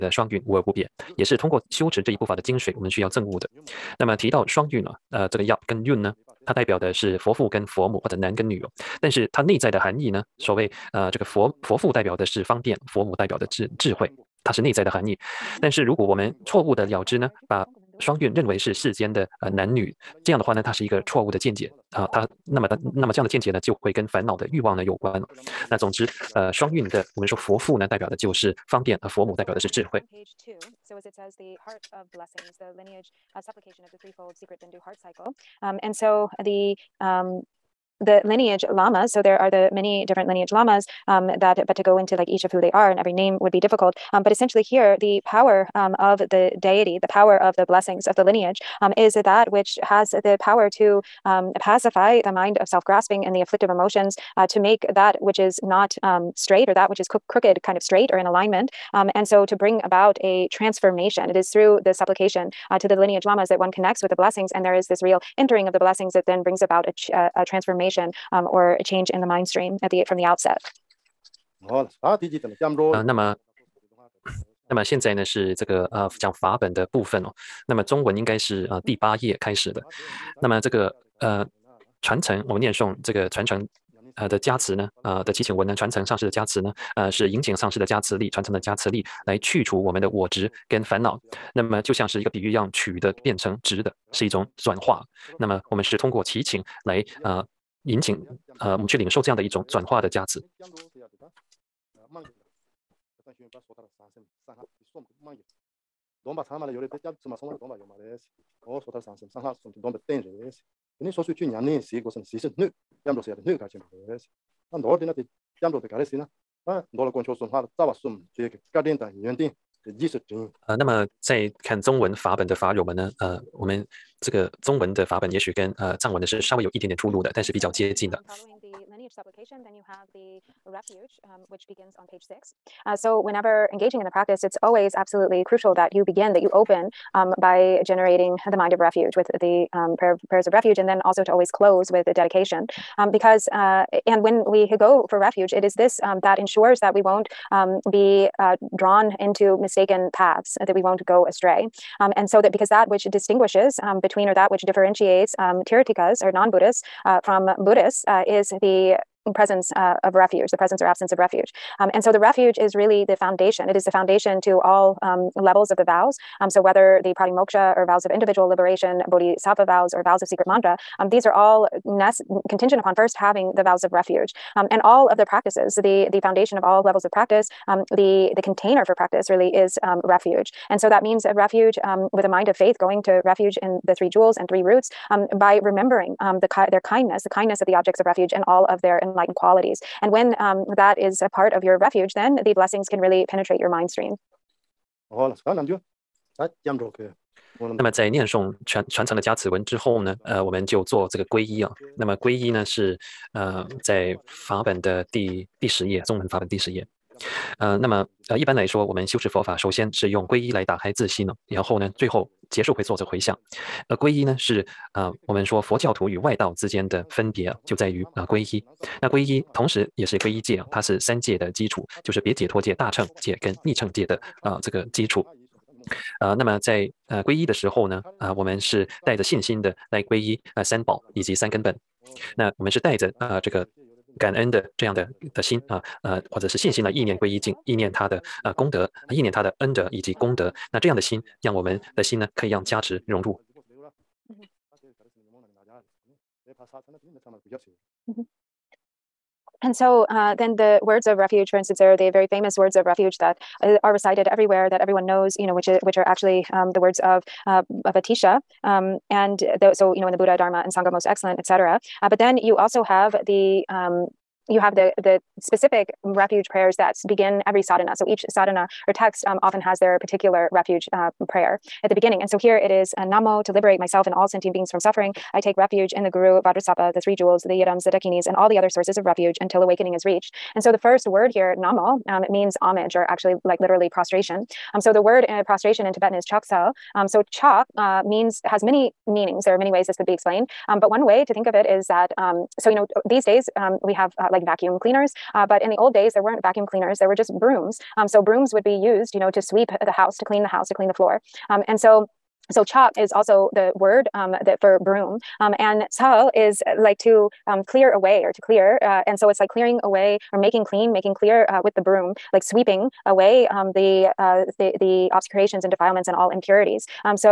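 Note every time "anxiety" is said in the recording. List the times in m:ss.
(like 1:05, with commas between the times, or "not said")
not said.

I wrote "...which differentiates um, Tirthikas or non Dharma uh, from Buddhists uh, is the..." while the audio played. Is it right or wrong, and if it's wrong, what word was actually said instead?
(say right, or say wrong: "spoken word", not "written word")
wrong: "Buddhists", not "Dharma".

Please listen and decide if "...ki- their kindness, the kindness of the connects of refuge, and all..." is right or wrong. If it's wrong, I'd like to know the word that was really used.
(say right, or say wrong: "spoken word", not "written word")
wrong: "objects", not "connects".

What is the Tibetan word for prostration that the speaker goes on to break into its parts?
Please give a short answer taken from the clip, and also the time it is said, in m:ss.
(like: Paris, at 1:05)
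chaksa, at 4:46.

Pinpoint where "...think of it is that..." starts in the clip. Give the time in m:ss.
4:51.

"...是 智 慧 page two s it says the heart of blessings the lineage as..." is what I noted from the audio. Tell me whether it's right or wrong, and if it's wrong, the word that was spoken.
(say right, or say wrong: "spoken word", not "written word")
right.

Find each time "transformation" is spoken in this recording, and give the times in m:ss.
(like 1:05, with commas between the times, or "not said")
1:00, 1:07.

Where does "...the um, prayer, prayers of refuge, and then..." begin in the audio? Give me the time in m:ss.
2:19.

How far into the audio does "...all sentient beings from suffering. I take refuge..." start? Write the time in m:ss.
4:34.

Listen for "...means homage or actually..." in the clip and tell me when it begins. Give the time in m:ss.
4:42.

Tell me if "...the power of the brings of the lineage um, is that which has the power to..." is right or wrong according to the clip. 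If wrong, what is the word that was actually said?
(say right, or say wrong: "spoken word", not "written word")
wrong: "blessings", not "brings".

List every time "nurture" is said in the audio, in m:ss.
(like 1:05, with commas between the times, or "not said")
not said.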